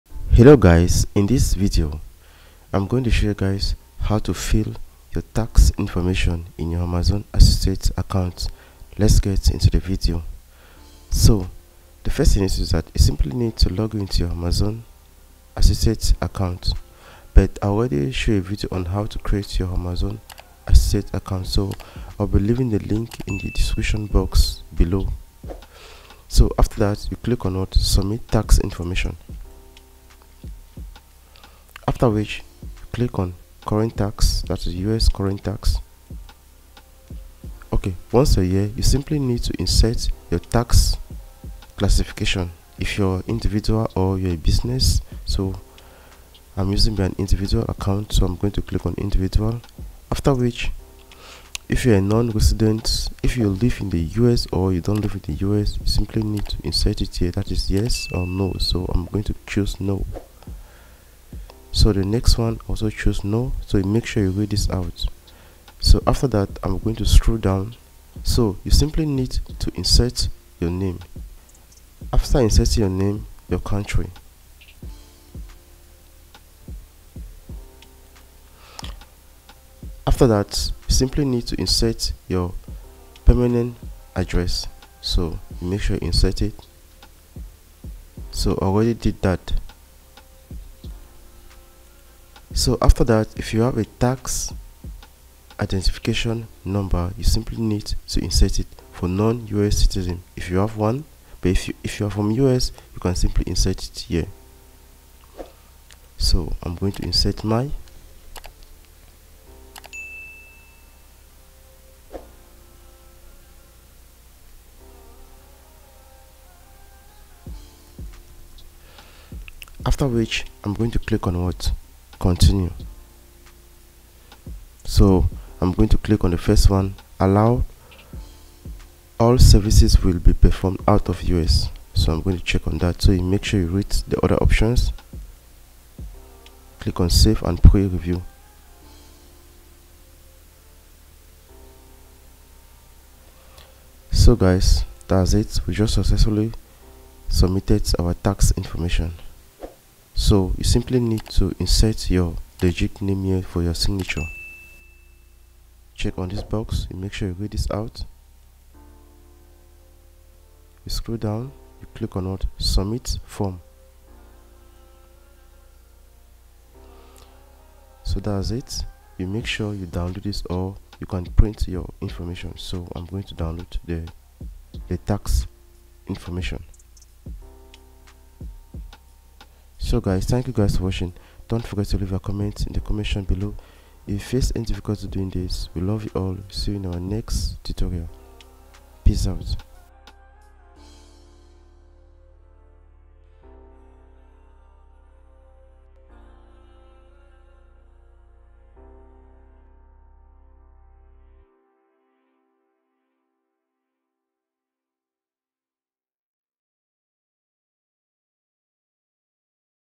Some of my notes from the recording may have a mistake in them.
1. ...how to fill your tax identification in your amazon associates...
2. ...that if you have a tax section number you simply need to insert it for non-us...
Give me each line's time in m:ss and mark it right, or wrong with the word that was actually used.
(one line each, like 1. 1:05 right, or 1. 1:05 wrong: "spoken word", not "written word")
1. 0:03 wrong: "information", not "identification"
2. 1:33 wrong: "identification", not "section".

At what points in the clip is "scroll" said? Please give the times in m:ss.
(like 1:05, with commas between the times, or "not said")
1:07, 2:40.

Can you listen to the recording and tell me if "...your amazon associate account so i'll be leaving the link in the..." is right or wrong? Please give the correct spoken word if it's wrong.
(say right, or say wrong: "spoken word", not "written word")
right.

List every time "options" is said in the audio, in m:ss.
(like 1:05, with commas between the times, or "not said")
2:14.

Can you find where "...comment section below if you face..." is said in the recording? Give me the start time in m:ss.
3:02.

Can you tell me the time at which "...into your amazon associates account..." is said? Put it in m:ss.
0:13.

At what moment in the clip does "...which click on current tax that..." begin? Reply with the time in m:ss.
0:32.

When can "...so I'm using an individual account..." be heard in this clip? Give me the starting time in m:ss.
0:45.